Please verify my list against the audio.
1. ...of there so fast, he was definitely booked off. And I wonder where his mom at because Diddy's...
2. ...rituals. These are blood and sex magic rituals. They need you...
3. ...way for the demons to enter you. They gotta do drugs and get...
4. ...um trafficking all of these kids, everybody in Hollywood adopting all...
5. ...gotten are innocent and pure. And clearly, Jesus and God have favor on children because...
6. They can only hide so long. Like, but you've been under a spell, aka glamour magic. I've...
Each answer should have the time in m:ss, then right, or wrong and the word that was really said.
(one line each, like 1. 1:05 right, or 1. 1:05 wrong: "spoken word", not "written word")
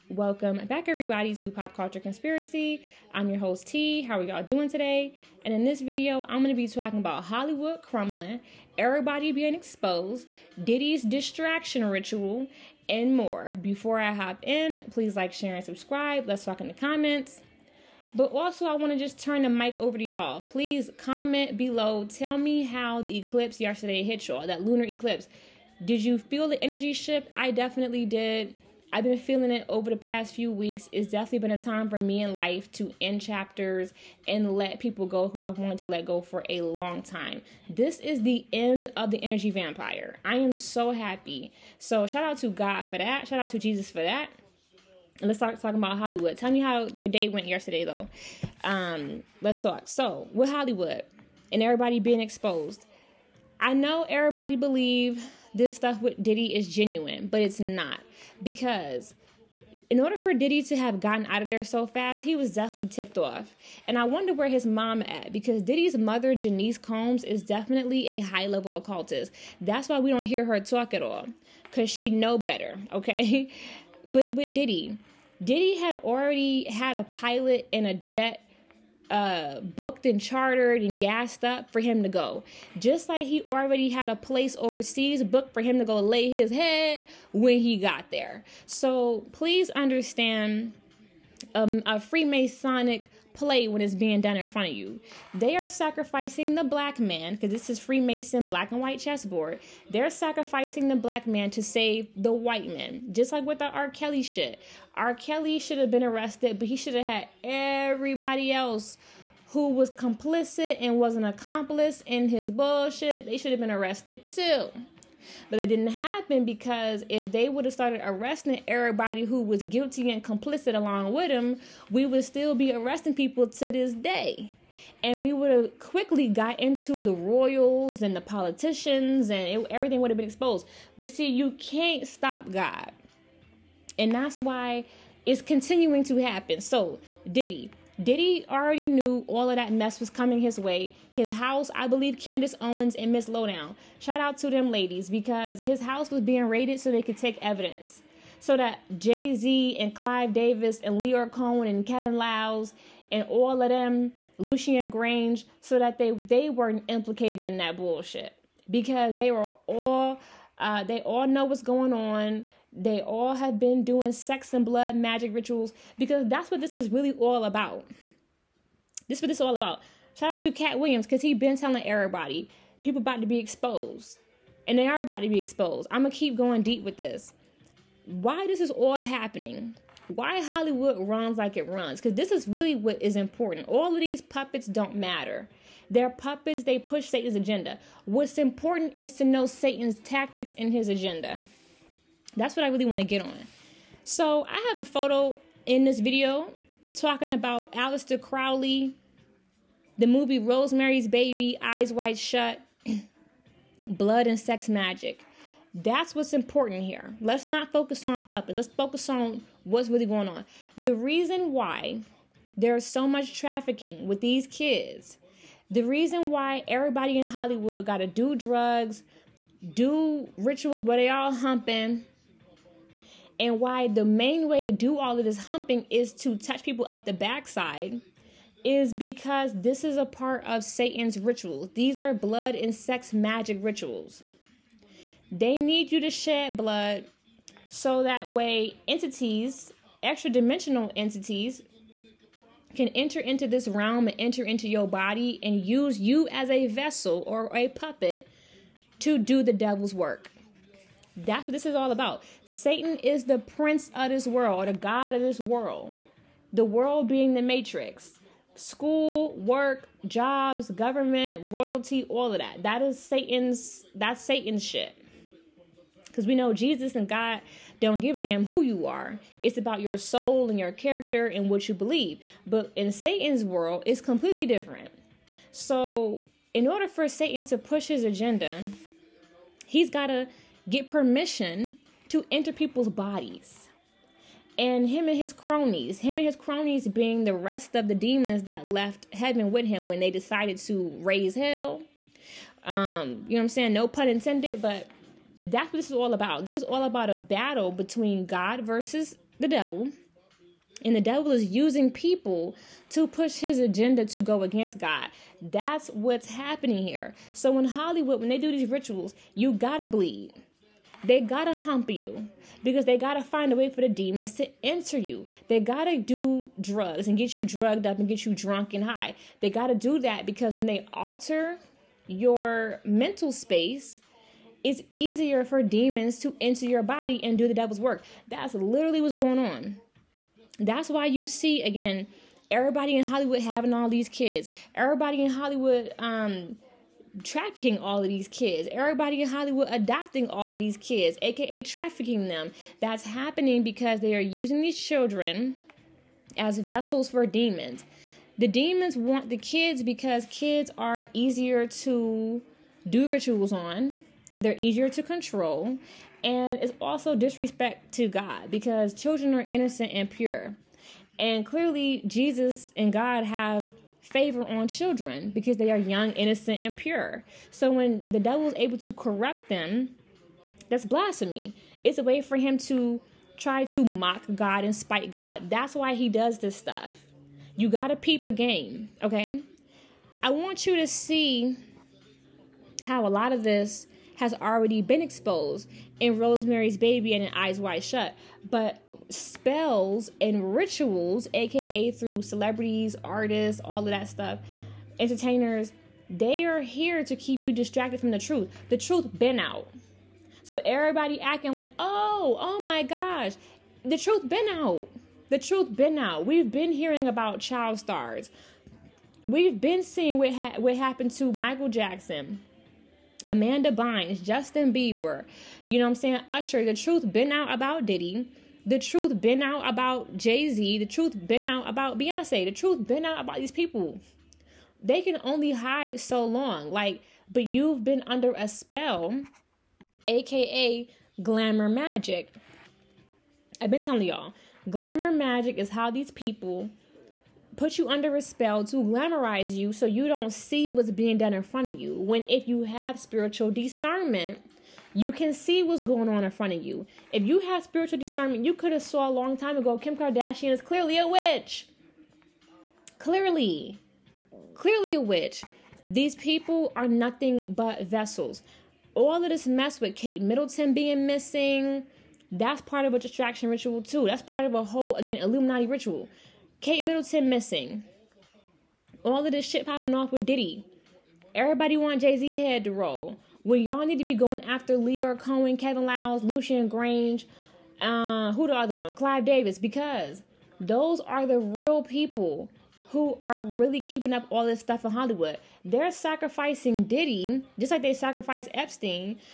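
1. 1:01 wrong: "tipped", not "booked"
2. 3:51 right
3. 5:13 right
4. 5:35 right
5. 5:58 wrong: "children", not "gotten"
6. 7:04 right.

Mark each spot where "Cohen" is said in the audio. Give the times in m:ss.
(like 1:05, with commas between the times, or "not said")
2:31, 7:55.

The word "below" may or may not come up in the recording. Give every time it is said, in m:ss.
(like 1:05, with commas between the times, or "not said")
0:21.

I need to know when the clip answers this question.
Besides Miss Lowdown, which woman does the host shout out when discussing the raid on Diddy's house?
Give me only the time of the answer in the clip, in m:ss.
2:22.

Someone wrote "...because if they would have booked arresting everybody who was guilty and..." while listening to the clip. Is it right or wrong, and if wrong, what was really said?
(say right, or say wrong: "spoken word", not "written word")
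wrong: "started", not "booked".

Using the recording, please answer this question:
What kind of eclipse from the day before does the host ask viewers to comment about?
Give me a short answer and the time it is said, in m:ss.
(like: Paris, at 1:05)
lunar eclipse, at 0:24.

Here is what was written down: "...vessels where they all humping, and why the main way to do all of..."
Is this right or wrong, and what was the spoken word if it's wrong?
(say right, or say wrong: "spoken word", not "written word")
wrong: "rituals", not "vessels".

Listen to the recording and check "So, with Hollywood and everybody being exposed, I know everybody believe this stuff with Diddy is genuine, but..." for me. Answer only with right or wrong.
right.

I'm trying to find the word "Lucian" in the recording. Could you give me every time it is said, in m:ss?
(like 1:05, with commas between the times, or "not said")
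2:34, 7:56.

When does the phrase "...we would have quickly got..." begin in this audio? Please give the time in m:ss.
2:05.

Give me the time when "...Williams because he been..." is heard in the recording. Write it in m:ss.
2:50.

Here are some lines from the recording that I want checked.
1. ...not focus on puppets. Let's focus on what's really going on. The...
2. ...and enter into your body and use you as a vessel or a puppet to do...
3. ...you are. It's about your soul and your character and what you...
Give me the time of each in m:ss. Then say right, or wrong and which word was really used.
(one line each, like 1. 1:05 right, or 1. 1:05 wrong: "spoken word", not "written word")
1. 3:27 right
2. 4:04 right
3. 4:28 right.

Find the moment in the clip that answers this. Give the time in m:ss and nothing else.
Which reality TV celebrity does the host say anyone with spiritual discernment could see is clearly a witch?
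7:29.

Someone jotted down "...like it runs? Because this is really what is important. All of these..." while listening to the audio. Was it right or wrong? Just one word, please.
right.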